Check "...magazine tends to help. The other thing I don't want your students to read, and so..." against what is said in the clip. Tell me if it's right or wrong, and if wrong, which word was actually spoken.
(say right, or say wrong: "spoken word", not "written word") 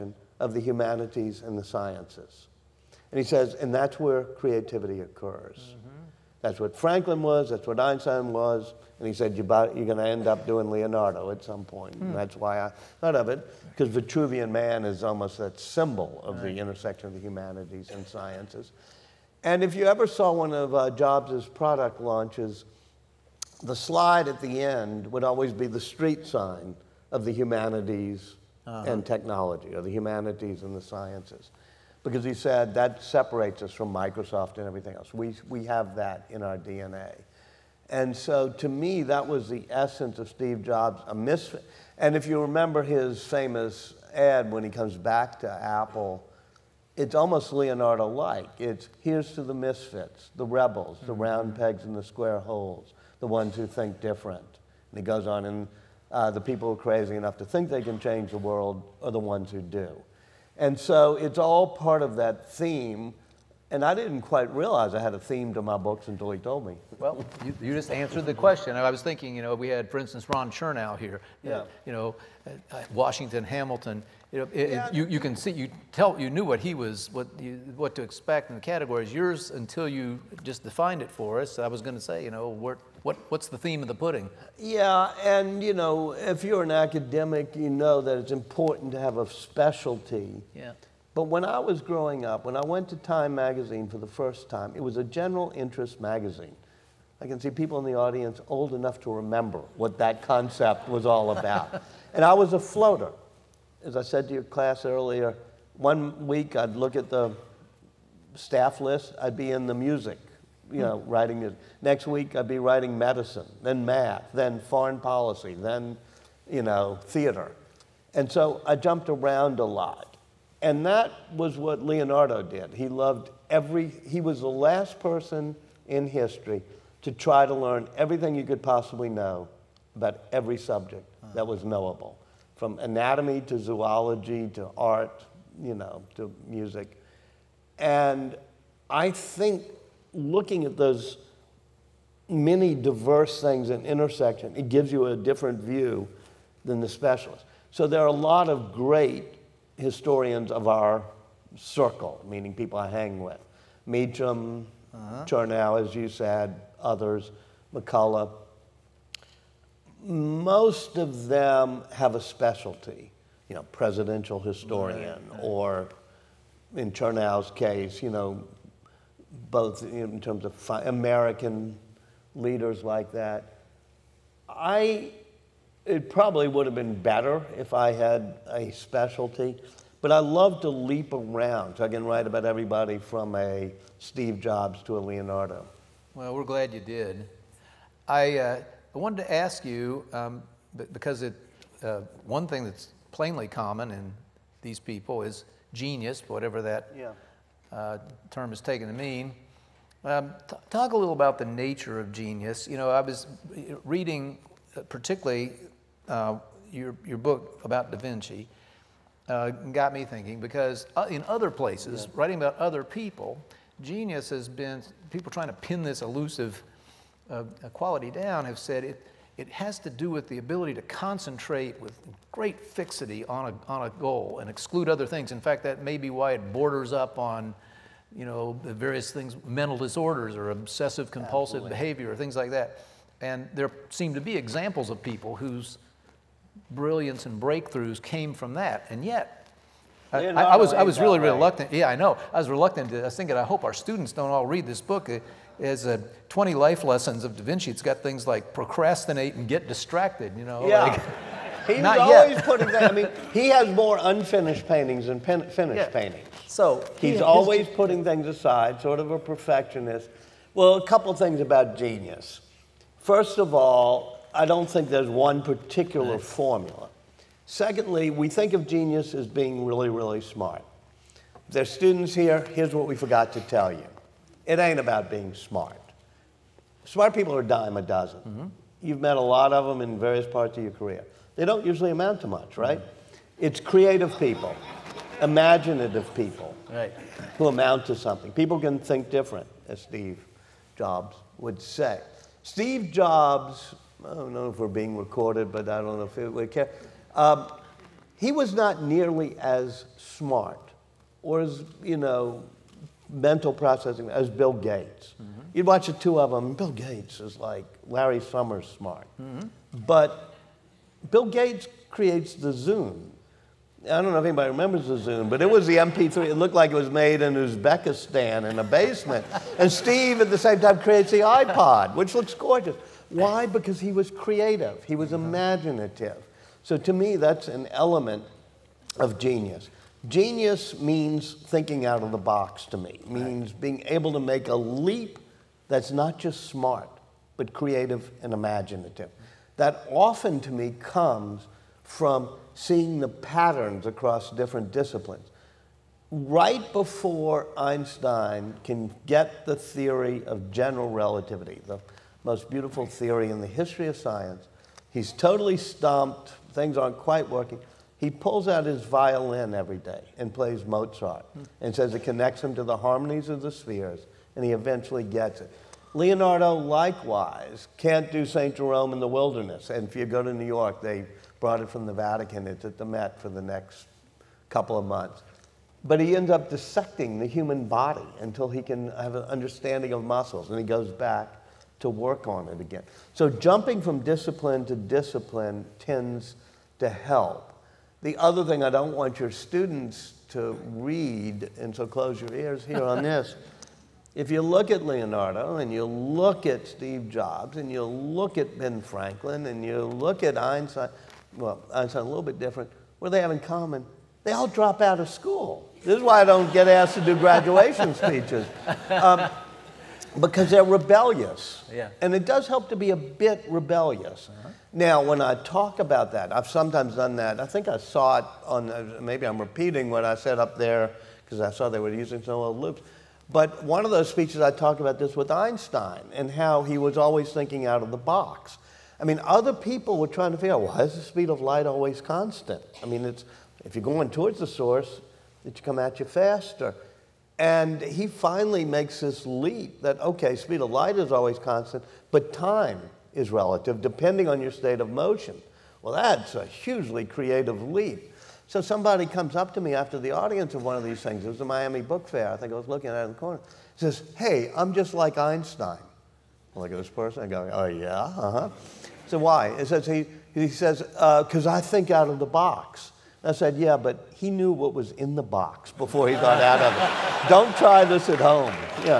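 wrong: "discipline", not "magazine".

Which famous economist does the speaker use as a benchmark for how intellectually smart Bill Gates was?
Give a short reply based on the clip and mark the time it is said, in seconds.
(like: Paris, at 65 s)
Larry Summers, at 307 s.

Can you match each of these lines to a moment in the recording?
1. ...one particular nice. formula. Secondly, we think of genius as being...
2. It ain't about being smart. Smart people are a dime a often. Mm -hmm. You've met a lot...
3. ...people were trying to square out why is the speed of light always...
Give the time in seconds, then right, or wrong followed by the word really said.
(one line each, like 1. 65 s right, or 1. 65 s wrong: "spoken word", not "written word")
1. 265 s right
2. 274 s wrong: "dozen", not "often"
3. 429 s wrong: "figure", not "square".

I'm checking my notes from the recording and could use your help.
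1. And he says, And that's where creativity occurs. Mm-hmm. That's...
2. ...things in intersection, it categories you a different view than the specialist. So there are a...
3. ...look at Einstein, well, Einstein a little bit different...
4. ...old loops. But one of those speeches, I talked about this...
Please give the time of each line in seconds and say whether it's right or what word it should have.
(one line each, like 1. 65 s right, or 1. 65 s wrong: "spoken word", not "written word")
1. 3 s right
2. 143 s wrong: "gives", not "categories"
3. 399 s right
4. 422 s right.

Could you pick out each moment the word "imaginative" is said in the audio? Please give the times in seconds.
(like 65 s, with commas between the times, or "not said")
285 s, 325 s, 338 s.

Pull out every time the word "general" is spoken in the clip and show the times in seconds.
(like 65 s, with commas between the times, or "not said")
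95 s, 350 s.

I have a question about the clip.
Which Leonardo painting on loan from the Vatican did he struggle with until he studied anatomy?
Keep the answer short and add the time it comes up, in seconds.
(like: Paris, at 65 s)
St. Jerome in the Wilderness, at 368 s.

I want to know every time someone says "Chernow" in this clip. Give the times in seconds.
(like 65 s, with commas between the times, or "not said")
70 s, 166 s.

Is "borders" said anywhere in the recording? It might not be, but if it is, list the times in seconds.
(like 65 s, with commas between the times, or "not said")
226 s.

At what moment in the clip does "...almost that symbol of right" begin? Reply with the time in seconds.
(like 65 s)
15 s.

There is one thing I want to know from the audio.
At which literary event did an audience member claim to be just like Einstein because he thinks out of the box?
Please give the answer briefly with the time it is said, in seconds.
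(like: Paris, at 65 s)
Miami Book Fair, at 451 s.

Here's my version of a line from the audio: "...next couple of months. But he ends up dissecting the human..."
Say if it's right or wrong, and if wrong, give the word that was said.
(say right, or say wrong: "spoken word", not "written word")
right.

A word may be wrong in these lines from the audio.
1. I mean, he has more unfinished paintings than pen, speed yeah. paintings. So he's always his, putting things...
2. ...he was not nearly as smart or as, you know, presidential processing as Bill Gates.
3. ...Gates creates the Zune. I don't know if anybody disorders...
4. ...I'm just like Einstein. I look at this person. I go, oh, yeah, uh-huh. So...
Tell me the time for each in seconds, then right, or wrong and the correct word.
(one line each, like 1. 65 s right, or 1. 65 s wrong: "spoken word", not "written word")
1. 252 s wrong: "finished", not "speed"
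2. 298 s wrong: "mental", not "presidential"
3. 311 s wrong: "remembers", not "disorders"
4. 454 s right.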